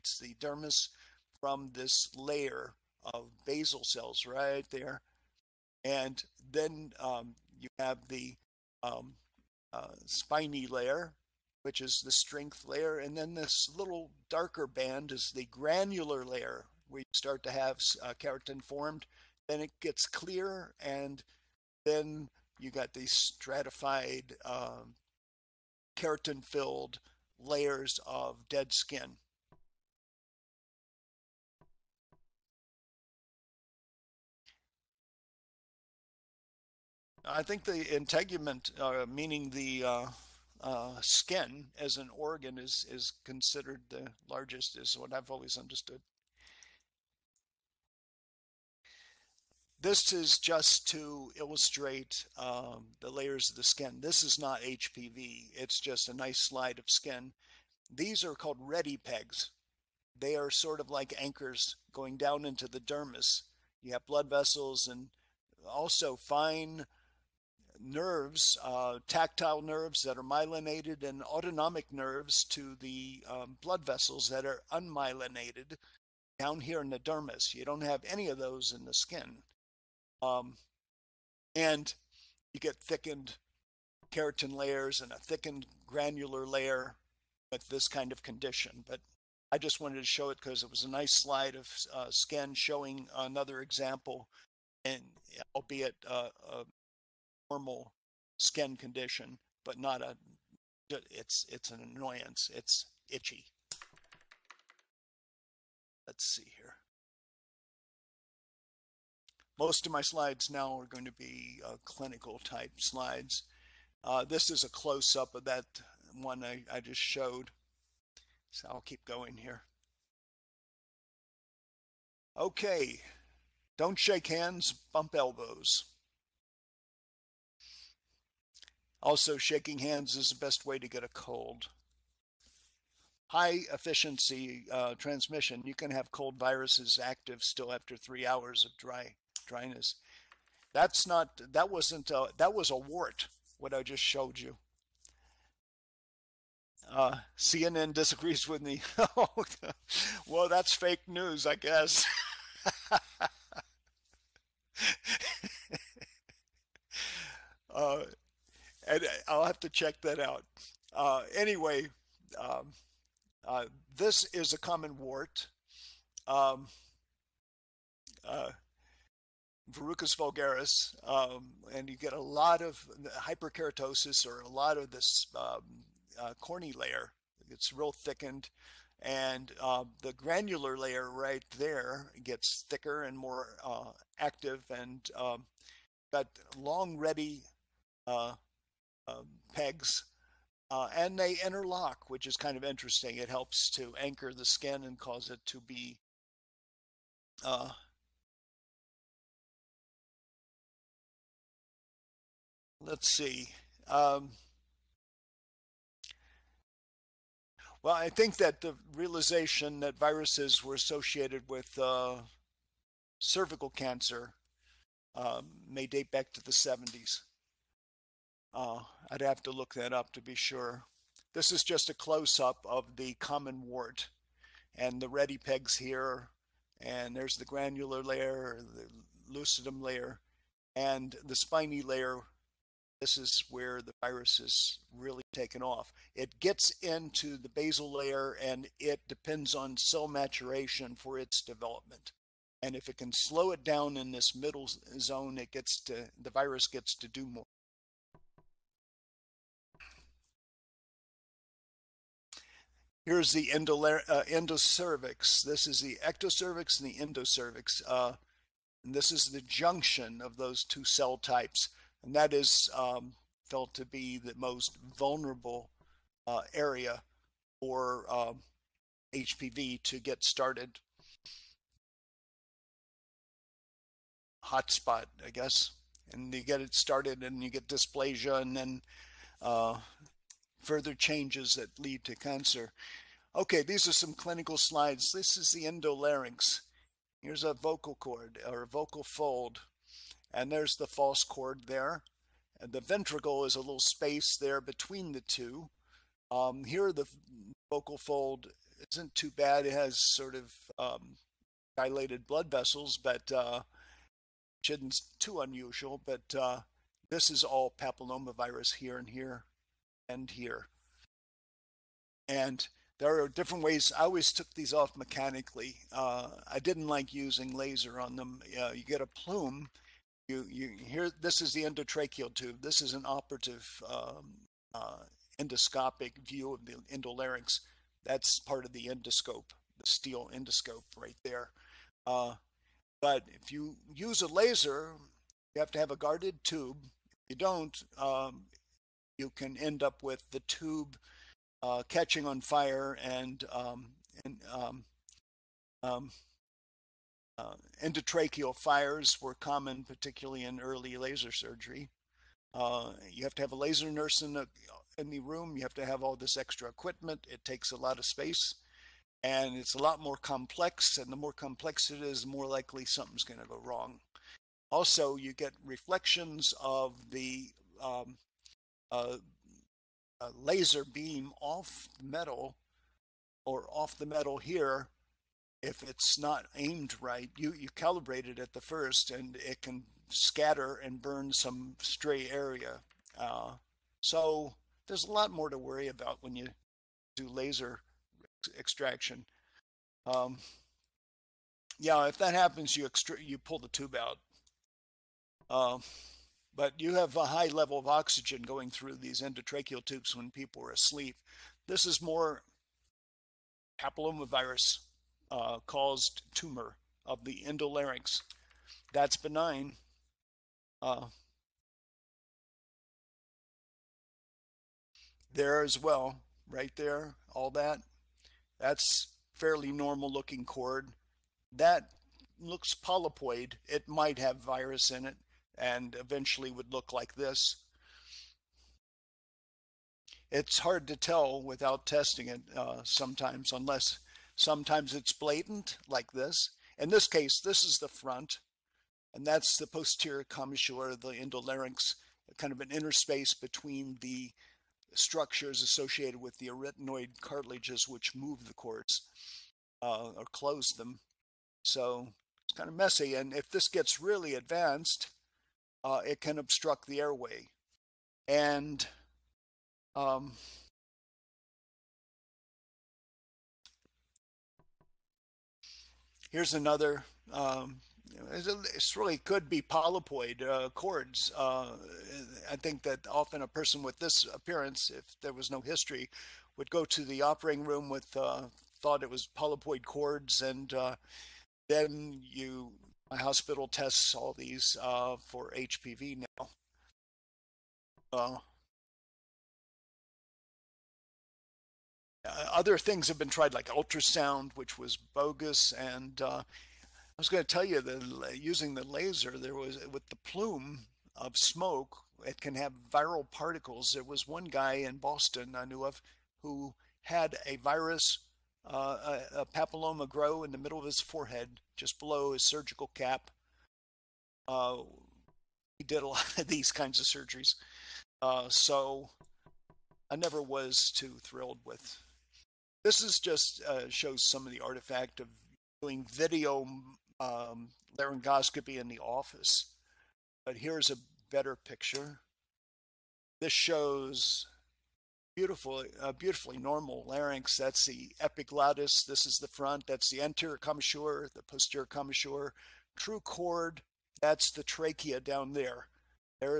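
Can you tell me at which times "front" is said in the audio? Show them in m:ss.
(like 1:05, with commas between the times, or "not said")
7:17, 8:59.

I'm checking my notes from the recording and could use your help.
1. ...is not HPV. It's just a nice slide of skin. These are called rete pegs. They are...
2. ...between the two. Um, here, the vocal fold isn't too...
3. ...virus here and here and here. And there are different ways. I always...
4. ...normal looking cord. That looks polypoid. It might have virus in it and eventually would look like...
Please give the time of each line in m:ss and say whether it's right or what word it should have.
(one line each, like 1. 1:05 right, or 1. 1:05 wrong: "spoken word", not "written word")
1. 0:54 right
2. 4:54 right
3. 5:07 wrong: "papillomavirus", not "virus"
4. 6:59 right.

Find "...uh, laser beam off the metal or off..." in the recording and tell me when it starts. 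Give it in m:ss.
6:08.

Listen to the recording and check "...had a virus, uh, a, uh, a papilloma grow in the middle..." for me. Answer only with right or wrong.
right.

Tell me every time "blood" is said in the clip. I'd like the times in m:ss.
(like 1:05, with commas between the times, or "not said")
1:04, 1:13, 5:02.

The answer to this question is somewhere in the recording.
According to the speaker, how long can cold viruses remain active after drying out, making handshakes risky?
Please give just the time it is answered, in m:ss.
2:17.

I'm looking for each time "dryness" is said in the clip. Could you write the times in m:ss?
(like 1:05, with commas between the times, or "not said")
2:19.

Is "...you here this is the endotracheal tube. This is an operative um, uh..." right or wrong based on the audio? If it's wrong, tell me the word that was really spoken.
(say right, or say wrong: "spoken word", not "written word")
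right.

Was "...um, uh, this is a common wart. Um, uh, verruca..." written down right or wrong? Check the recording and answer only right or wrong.
right.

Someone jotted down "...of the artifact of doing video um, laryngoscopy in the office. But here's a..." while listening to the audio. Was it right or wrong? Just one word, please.
right.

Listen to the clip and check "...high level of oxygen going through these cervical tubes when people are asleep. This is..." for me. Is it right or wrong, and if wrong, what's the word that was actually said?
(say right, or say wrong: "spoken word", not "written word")
wrong: "endotracheal", not "cervical".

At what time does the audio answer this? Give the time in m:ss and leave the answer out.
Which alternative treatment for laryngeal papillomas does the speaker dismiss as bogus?
8:13.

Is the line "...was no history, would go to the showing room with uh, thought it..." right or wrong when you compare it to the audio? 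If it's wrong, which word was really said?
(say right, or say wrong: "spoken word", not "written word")
wrong: "operating", not "showing".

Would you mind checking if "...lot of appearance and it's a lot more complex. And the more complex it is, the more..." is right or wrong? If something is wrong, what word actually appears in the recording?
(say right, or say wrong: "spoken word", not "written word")
wrong: "space", not "appearance".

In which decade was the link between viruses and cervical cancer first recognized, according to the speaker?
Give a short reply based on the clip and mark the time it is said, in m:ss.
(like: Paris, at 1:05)
the 70s, at 3:36.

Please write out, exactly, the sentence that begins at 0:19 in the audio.
Then it gets clear and then you got these stratified um, keratin filled layers of dead skin.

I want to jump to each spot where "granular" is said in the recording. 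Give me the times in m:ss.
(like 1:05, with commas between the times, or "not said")
0:15, 1:25, 3:00, 3:47.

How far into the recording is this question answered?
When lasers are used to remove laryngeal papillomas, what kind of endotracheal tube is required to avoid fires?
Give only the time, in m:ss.
5:35.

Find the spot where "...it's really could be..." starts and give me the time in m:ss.
7:48.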